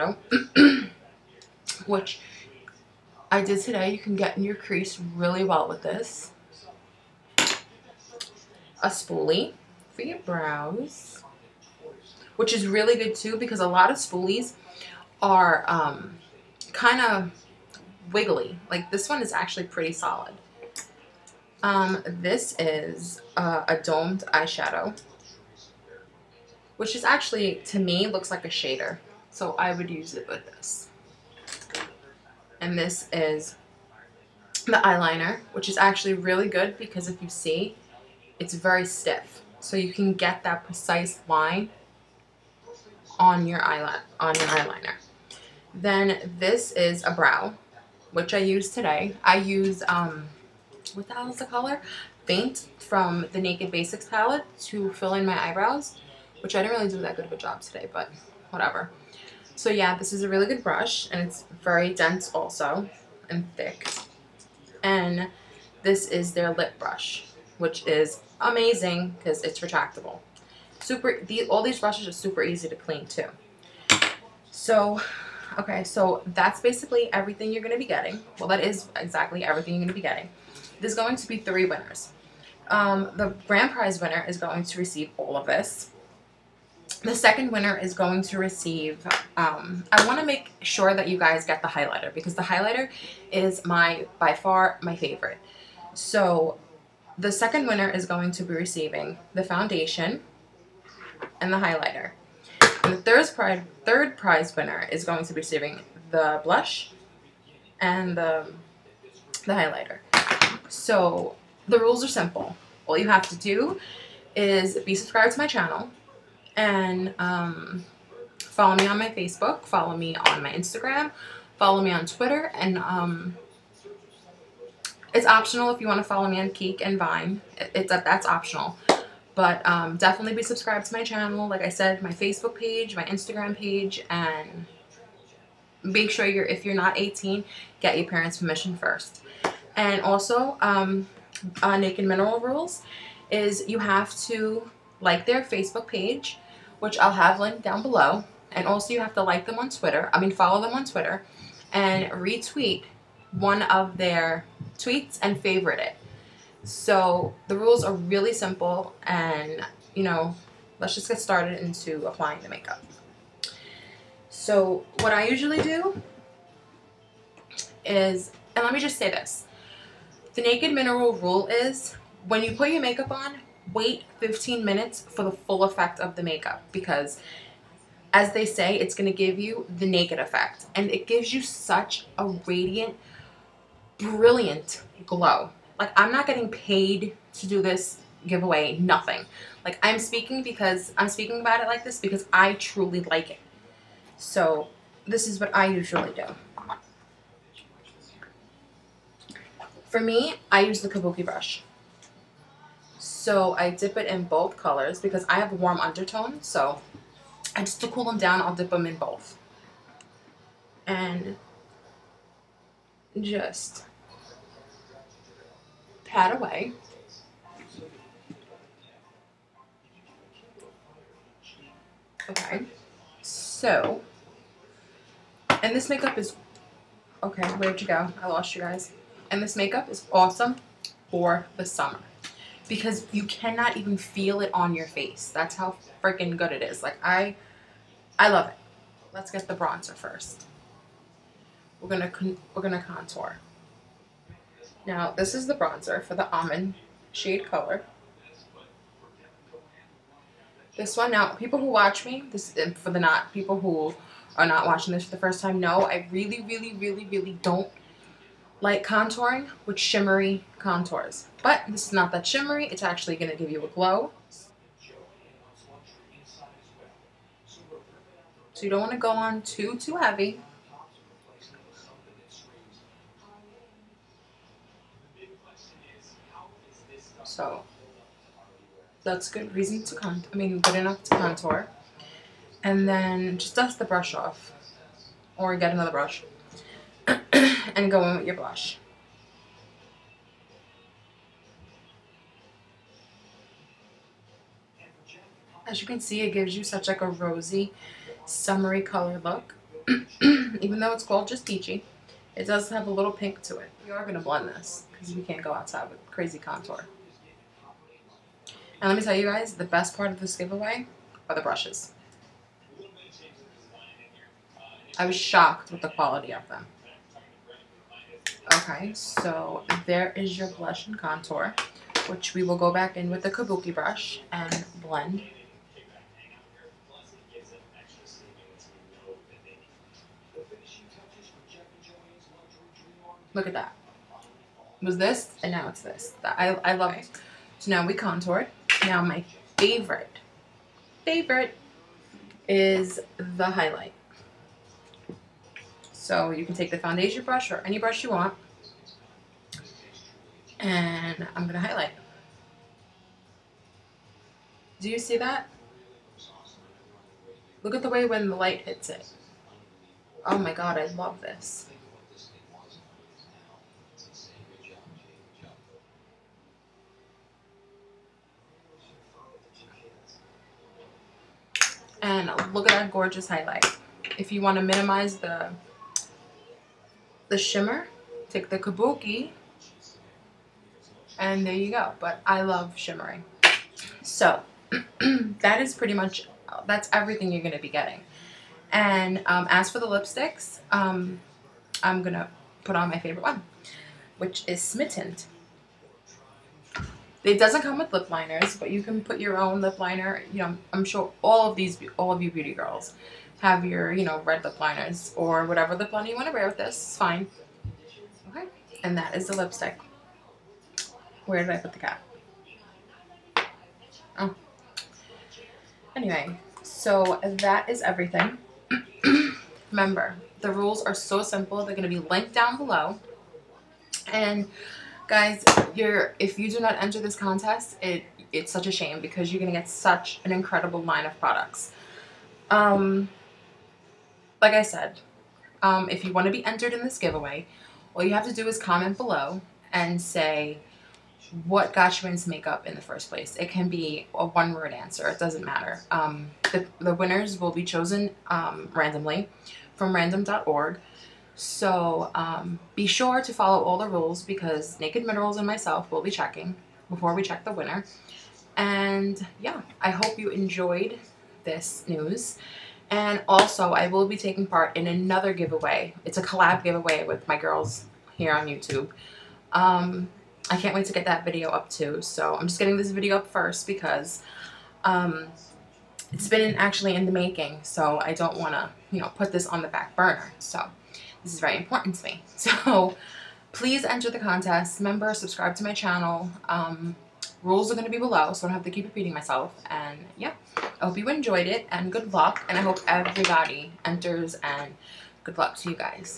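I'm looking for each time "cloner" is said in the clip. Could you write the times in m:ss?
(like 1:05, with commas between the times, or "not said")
not said.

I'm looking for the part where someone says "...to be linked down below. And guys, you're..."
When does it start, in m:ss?
7:01.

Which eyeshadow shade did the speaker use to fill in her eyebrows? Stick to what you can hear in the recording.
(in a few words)
Faint.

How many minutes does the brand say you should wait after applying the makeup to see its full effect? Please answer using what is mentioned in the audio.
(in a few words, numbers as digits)
15.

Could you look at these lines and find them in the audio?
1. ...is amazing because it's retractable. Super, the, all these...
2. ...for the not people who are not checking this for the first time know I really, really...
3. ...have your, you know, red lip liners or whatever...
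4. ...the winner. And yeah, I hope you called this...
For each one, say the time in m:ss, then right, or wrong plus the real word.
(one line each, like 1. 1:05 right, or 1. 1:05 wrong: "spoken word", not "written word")
1. 1:07 right
2. 4:12 wrong: "watching", not "checking"
3. 6:43 right
4. 7:37 wrong: "enjoyed", not "called".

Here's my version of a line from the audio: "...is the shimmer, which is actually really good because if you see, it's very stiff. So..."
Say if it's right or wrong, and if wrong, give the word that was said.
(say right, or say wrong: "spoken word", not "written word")
wrong: "eyeliner", not "shimmer".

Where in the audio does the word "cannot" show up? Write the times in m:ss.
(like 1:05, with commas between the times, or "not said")
3:53.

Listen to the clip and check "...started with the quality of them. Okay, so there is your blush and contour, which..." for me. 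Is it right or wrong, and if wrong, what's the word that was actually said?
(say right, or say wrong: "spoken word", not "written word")
wrong: "shocked", not "started".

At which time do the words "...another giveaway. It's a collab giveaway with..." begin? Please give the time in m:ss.
7:44.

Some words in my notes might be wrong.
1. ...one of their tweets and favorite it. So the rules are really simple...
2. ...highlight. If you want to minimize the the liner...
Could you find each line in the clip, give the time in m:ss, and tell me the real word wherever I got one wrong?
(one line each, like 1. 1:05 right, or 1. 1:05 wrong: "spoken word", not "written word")
1. 2:33 right
2. 6:13 wrong: "shimmer", not "liner".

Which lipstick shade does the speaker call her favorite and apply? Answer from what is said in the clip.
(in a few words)
Smitten.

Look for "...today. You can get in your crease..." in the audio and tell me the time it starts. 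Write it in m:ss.
0:03.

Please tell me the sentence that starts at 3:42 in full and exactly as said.
Okay, so, and this makeup is, okay, where'd you go?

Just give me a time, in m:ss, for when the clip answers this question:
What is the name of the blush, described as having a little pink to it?
5:01.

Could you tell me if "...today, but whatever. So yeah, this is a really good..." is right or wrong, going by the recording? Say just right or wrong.
right.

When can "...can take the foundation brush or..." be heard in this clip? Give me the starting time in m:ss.
5:46.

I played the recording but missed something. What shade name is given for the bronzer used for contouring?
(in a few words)
almond.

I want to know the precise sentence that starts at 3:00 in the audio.
And it gives you such a radiant, brilliant glow.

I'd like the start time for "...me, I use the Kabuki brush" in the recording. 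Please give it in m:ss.
3:19.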